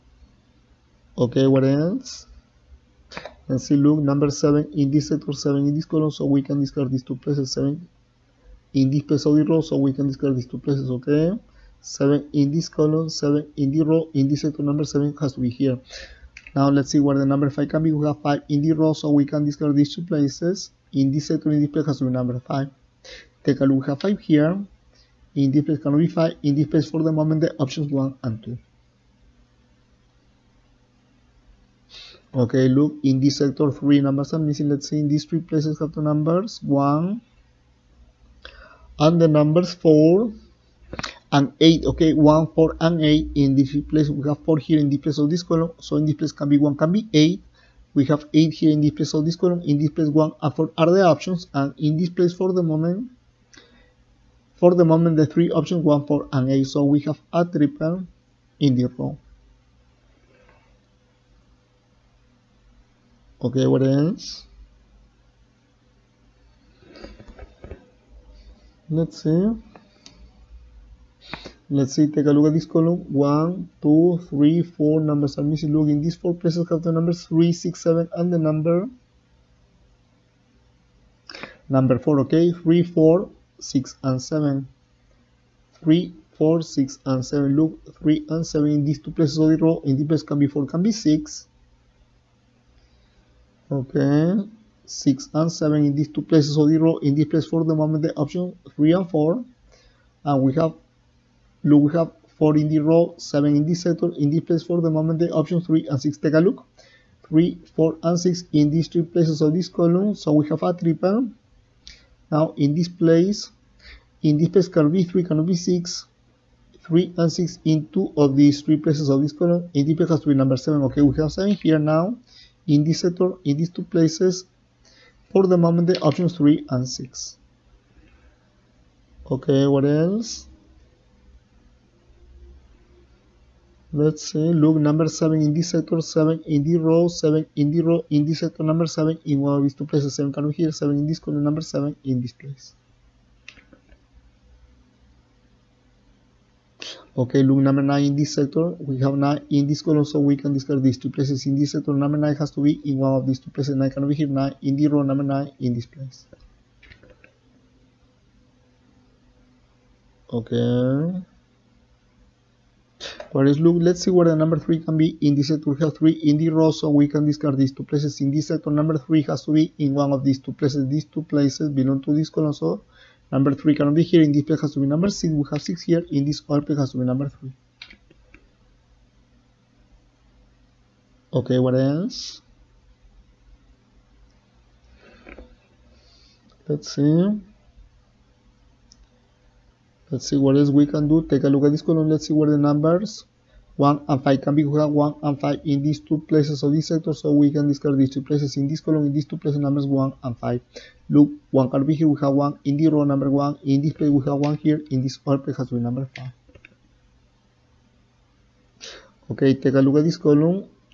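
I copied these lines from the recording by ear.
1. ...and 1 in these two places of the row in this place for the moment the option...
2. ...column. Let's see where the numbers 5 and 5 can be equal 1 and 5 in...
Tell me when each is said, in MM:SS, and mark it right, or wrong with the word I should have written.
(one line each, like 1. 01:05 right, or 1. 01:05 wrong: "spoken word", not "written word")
1. 01:35 wrong: "7", not "1"
2. 03:11 wrong: "1", not "5".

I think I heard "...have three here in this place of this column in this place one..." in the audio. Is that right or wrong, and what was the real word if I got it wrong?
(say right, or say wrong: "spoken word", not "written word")
wrong: "eight", not "three".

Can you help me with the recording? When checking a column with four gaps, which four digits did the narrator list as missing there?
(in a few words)
3, 4, 6 and 7.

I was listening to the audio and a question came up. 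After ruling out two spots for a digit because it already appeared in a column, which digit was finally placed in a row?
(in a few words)
9.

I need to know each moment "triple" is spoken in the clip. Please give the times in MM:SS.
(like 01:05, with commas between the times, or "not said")
00:57, 01:50.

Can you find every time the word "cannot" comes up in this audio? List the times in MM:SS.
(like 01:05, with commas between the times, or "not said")
00:25, 02:33, 02:53.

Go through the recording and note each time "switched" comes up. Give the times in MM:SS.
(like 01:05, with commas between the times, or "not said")
not said.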